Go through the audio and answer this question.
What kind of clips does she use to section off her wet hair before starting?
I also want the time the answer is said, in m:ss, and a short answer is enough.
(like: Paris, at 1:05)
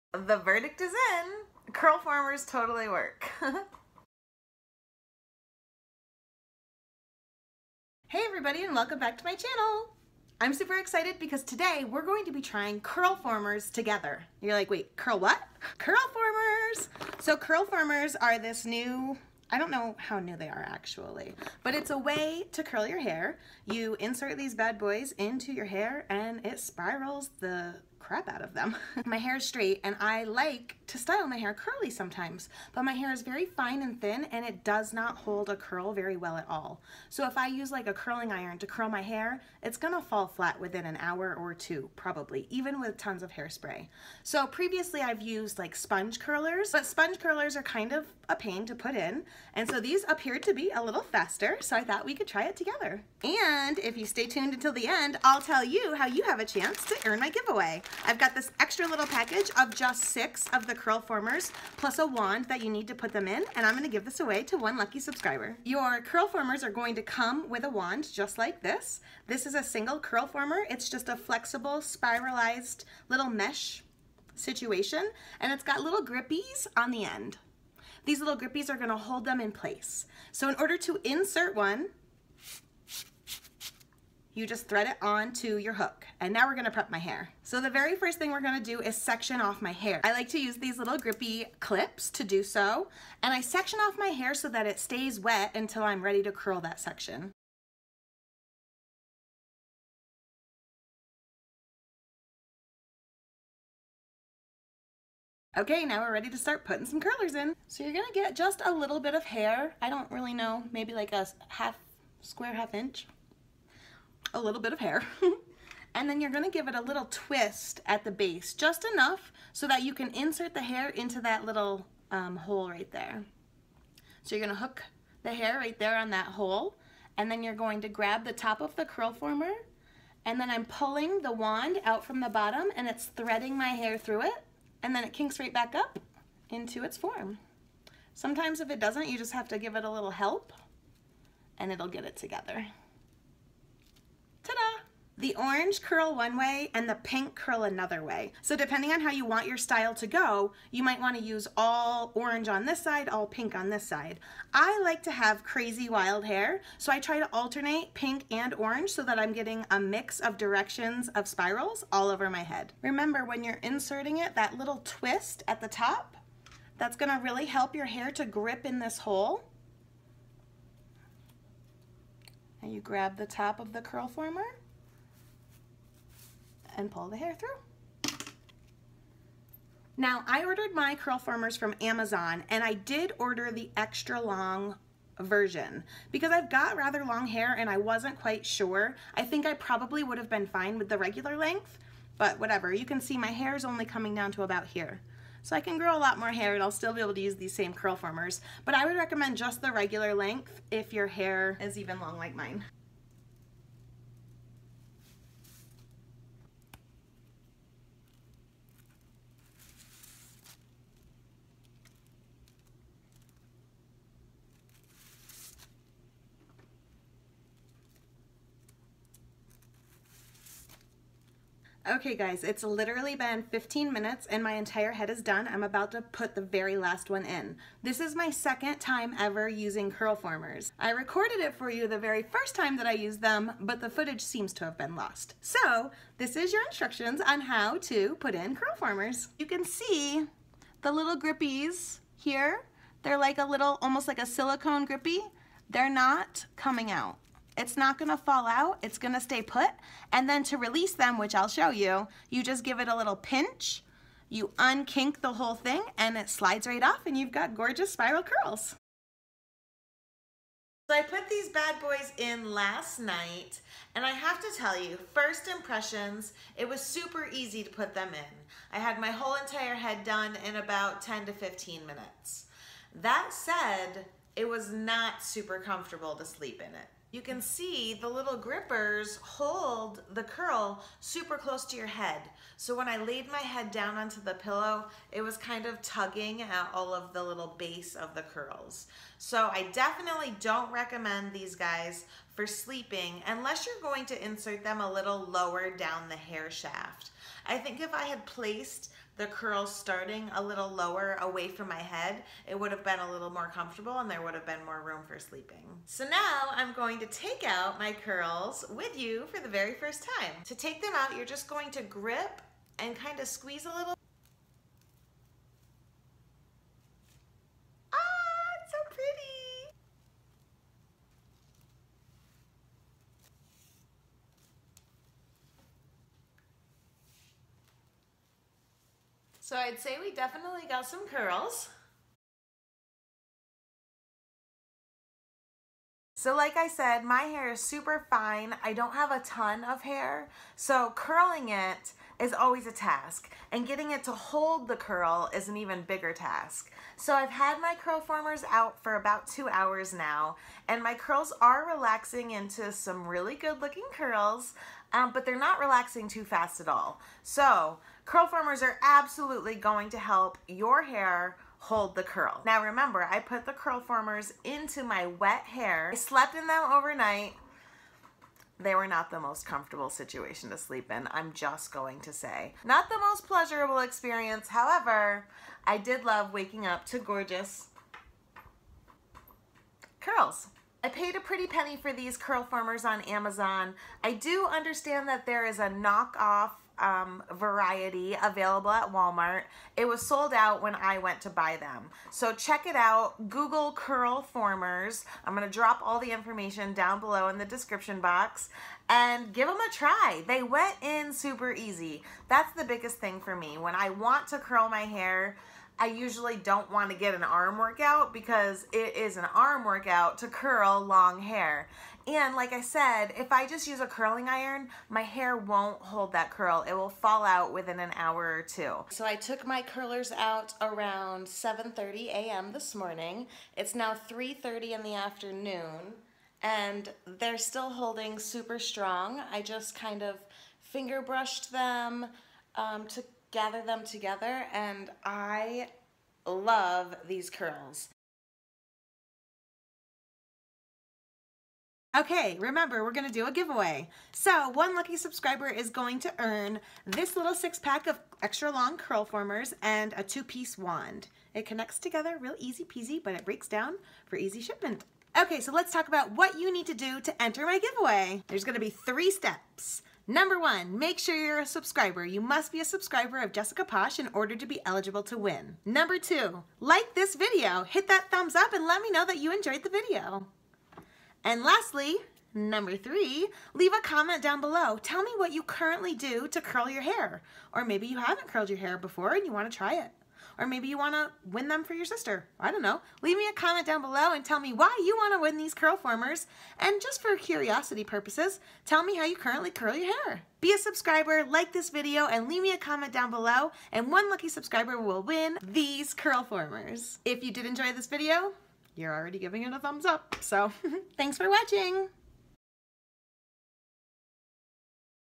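Grippy clips, at 1:30.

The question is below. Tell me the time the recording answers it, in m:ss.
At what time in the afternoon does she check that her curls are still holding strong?
7:04.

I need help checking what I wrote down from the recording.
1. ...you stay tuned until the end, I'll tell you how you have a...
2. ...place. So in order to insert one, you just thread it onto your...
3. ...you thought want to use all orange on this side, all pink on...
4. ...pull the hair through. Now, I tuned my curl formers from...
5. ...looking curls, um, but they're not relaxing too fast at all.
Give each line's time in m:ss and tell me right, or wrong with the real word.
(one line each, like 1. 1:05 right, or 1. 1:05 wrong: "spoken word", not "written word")
1. 0:53 right
2. 1:19 right
3. 2:30 wrong: "might", not "thought"
4. 2:56 wrong: "ordered", not "tuned"
5. 5:53 right.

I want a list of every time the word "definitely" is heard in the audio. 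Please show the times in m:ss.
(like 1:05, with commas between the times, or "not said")
4:49, 5:30.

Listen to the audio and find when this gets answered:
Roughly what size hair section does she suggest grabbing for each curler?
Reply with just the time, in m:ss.
1:52.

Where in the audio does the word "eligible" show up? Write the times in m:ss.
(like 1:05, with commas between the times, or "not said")
7:44.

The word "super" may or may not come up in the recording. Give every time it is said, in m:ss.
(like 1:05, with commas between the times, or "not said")
0:10, 4:26, 4:35, 4:41, 5:37, 6:41, 7:08.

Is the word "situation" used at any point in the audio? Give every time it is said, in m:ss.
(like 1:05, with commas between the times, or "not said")
1:14, 6:09.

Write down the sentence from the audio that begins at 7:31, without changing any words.
It connects together real easy peasy, but it breaks down for easy shipment.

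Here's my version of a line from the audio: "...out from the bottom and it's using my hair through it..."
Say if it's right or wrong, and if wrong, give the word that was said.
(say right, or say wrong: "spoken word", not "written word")
wrong: "threading", not "using".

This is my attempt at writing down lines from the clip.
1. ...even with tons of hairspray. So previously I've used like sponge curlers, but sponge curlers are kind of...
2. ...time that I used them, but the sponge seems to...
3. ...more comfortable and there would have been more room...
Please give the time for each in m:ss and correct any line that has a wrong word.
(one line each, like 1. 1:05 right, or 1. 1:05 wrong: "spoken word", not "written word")
1. 0:42 right
2. 3:52 wrong: "footage", not "sponge"
3. 5:03 right.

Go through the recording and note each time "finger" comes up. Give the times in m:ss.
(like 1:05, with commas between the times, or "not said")
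7:10.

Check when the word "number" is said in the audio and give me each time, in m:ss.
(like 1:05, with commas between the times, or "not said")
7:40, 7:45, 7:52.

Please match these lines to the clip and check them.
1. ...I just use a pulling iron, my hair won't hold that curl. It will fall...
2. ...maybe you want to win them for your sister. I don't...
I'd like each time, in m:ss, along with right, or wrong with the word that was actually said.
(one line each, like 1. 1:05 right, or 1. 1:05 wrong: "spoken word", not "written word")
1. 6:53 wrong: "curling", not "pulling"
2. 8:00 right.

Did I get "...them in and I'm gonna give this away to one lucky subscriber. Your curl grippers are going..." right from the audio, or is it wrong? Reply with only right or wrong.
wrong.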